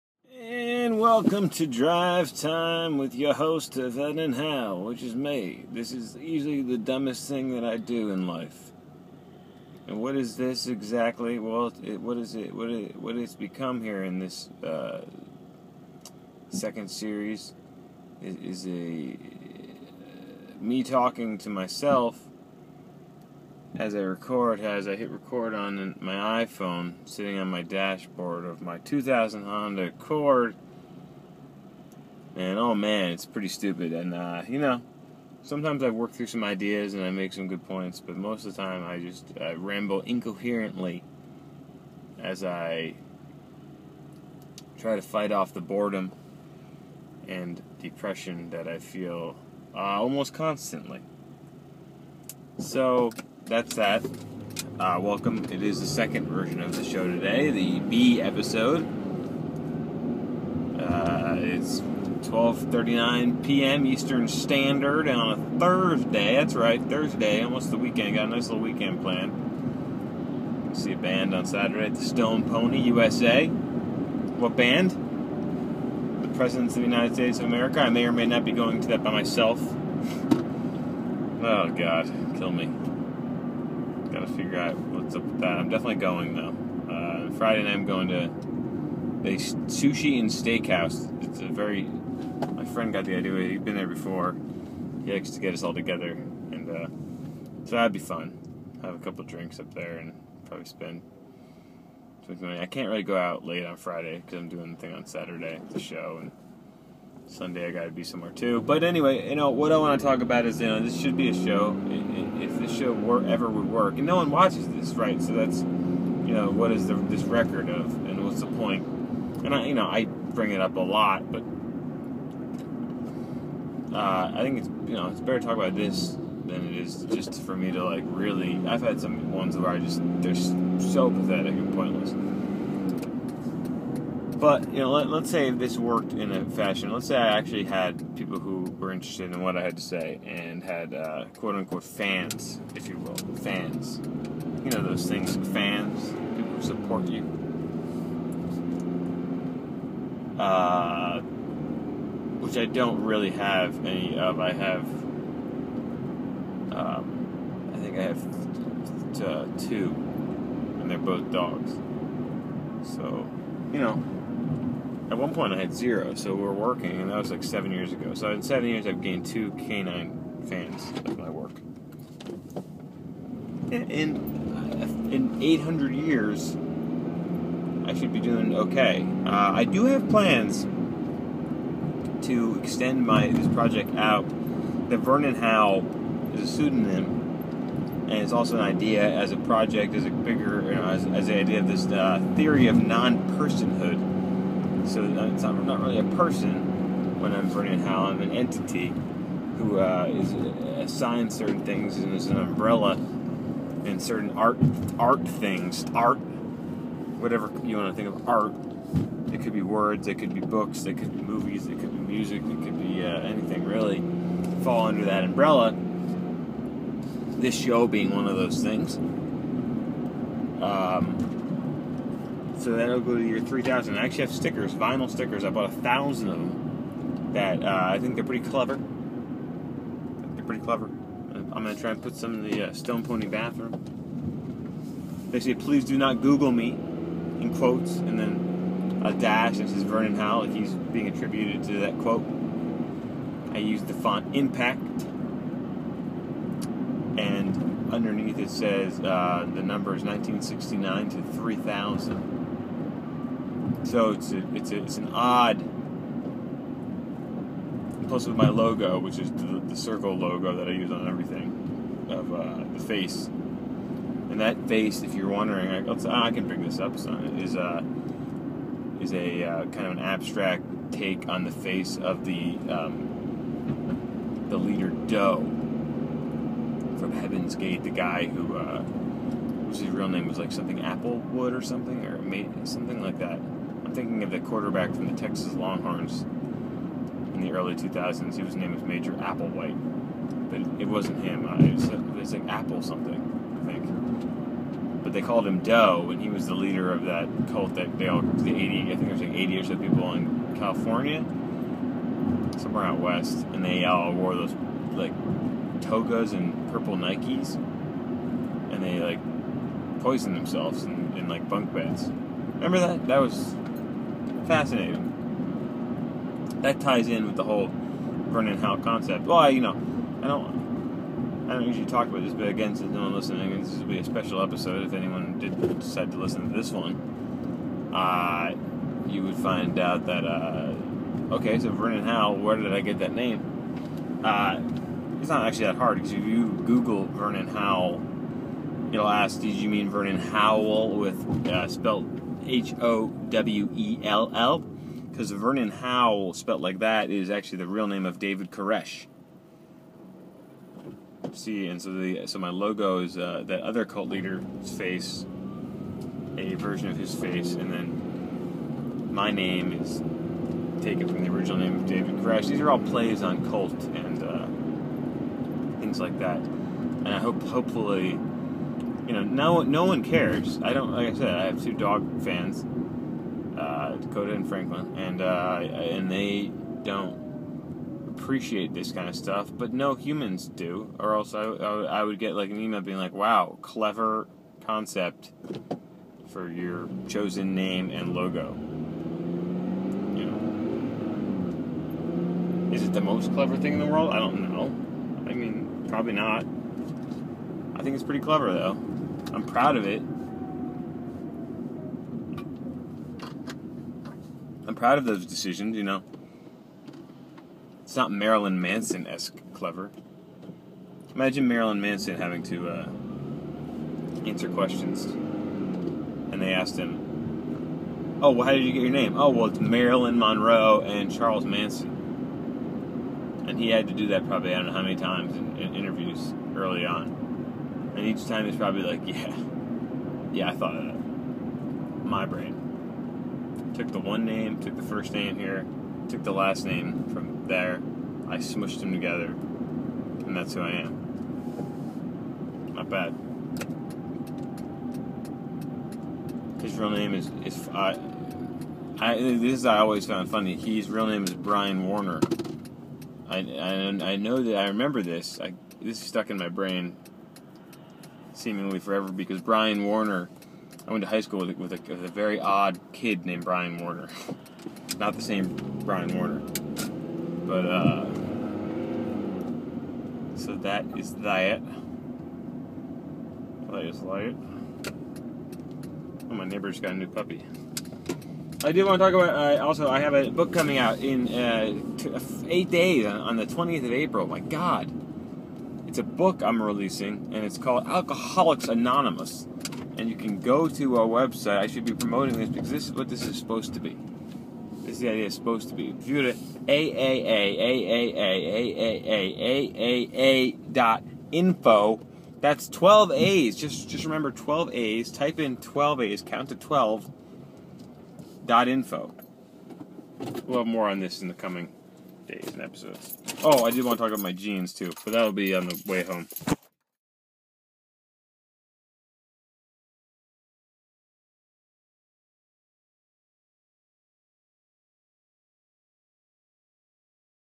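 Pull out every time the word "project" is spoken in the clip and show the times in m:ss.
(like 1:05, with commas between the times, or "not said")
3:03, 3:09.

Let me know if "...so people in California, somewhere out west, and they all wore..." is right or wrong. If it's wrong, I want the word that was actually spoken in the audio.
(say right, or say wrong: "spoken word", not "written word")
right.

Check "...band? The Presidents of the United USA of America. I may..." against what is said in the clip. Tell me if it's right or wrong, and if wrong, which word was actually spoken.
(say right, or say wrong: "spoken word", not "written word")
wrong: "States", not "USA".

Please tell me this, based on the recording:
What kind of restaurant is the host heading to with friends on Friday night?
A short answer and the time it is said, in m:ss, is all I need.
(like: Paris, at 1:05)
sushi and steakhouse, at 1:29.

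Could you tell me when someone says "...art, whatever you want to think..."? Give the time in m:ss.
3:25.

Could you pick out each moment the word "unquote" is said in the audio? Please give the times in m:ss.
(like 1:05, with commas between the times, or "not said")
2:21.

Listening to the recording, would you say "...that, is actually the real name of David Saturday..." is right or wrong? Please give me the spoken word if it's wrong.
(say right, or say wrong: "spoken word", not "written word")
wrong: "Koresh", not "Saturday".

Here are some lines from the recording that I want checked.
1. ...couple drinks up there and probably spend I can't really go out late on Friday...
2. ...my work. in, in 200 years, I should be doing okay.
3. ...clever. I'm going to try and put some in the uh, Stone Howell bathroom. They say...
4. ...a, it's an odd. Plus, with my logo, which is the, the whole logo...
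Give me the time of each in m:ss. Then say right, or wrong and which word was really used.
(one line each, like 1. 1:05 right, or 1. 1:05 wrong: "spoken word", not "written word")
1. 1:38 right
2. 2:51 wrong: "800", not "200"
3. 3:50 wrong: "Pony", not "Howell"
4. 4:14 wrong: "circle", not "whole".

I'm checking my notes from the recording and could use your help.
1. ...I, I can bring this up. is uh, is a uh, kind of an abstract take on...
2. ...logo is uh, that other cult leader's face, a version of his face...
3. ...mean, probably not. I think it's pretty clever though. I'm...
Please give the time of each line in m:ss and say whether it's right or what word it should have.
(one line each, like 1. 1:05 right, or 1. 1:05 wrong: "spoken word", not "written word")
1. 4:25 right
2. 5:52 right
3. 6:35 right.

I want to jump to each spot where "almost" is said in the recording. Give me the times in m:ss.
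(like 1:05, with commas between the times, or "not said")
0:49, 1:07.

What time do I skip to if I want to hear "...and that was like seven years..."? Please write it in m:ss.
2:46.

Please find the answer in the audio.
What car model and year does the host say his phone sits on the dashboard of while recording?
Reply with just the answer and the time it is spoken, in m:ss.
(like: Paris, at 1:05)
2000 Honda Accord, at 0:28.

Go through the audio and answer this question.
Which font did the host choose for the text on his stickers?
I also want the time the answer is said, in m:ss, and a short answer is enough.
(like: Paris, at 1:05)
Impact, at 4:04.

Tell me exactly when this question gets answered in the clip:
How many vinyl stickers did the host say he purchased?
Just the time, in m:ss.
3:45.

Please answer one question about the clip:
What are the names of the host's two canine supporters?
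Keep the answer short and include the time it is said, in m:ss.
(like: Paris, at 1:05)
Dakota and Franklin, at 6:13.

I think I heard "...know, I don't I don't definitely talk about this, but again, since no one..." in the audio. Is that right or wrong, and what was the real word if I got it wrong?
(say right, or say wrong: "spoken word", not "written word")
wrong: "usually", not "definitely".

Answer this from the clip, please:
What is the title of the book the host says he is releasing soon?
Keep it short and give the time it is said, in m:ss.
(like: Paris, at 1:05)
Alcoholics Anonymous, at 8:07.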